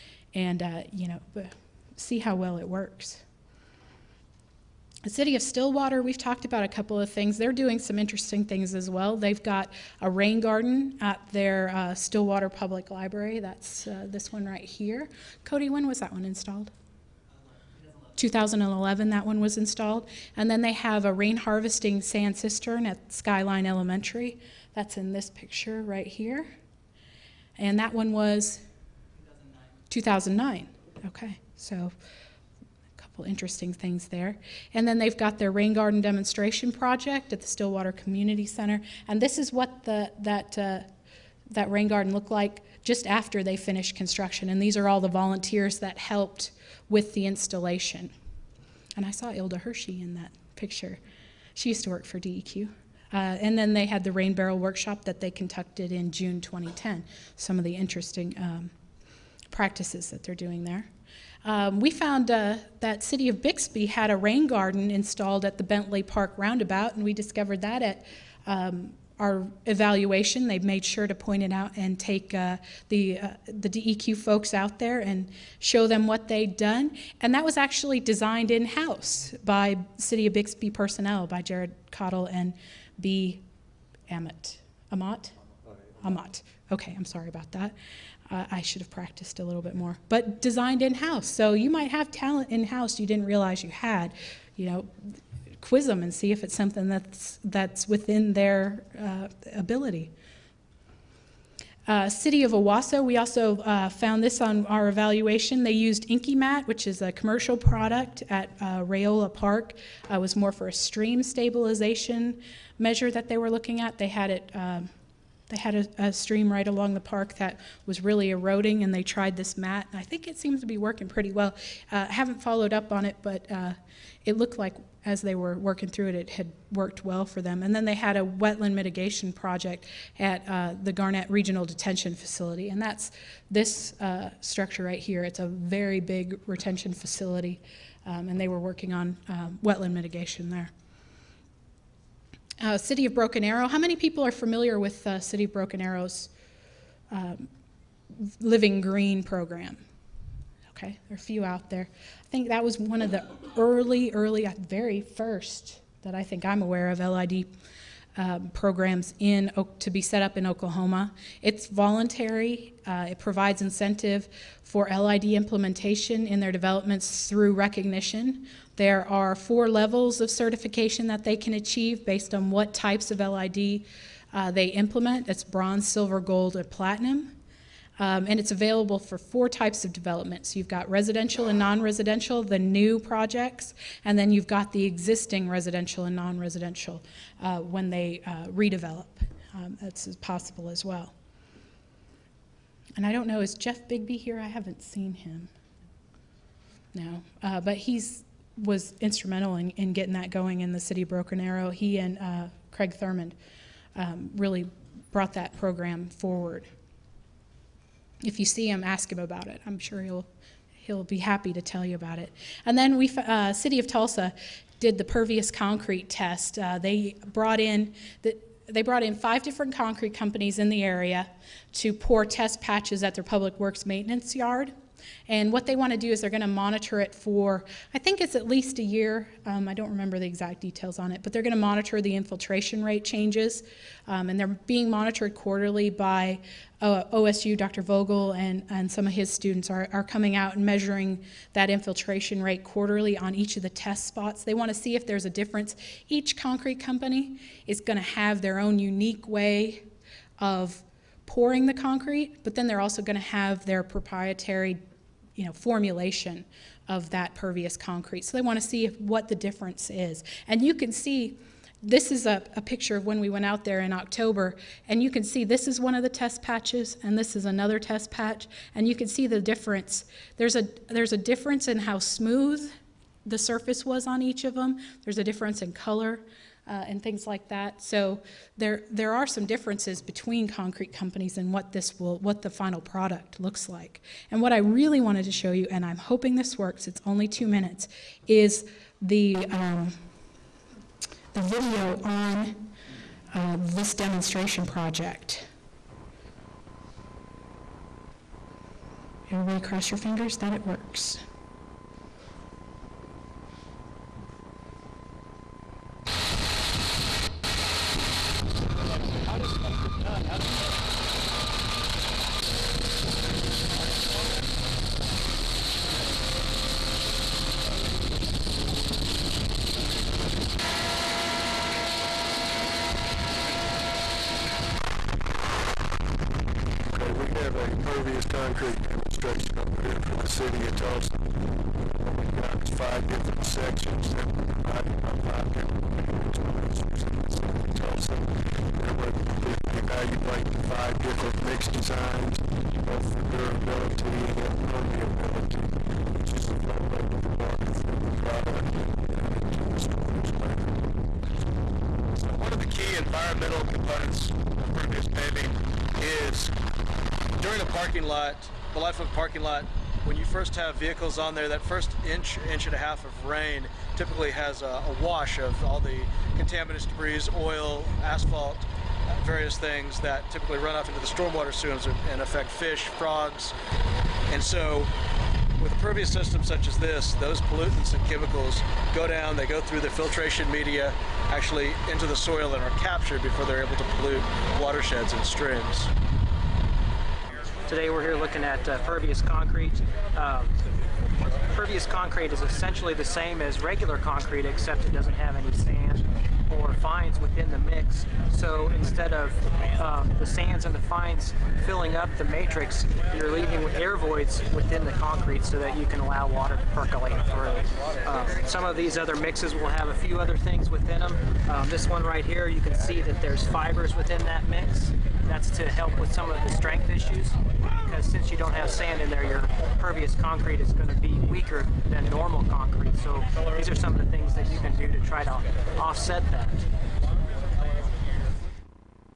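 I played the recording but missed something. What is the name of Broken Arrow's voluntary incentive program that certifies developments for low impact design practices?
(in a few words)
Living Green.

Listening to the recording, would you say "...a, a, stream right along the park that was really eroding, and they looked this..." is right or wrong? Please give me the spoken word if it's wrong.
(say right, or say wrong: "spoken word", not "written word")
wrong: "tried", not "looked".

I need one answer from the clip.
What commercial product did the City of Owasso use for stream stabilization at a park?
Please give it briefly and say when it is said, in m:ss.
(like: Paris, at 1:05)
Enkamat, at 1:46.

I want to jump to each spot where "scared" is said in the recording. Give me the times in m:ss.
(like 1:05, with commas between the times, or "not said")
not said.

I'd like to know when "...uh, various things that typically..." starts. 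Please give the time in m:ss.
6:09.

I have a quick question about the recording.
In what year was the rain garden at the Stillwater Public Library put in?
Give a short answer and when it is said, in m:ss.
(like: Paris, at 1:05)
2011, at 0:18.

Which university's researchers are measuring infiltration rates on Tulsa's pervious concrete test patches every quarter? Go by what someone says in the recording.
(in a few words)
OSU.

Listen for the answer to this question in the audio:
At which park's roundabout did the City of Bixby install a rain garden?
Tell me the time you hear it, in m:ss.
1:05.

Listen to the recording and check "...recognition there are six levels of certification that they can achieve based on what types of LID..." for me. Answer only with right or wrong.
wrong.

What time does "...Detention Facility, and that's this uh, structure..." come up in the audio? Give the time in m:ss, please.
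2:11.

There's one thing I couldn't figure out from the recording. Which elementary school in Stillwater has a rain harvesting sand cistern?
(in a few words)
Skyline Elementary.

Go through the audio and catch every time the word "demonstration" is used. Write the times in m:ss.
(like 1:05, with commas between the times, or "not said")
0:36, 4:53, 5:28.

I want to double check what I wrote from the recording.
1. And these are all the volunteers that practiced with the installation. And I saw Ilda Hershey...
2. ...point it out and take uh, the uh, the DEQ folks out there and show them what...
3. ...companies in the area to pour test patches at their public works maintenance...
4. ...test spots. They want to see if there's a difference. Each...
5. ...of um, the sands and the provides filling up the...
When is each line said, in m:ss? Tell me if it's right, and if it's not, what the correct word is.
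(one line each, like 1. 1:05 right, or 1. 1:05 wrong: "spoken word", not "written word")
1. 0:44 wrong: "helped", not "practiced"
2. 1:11 right
3. 3:40 right
4. 4:03 right
5. 6:39 wrong: "fines", not "provides".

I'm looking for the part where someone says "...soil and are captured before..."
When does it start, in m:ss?
6:22.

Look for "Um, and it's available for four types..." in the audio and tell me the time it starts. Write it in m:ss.
2:57.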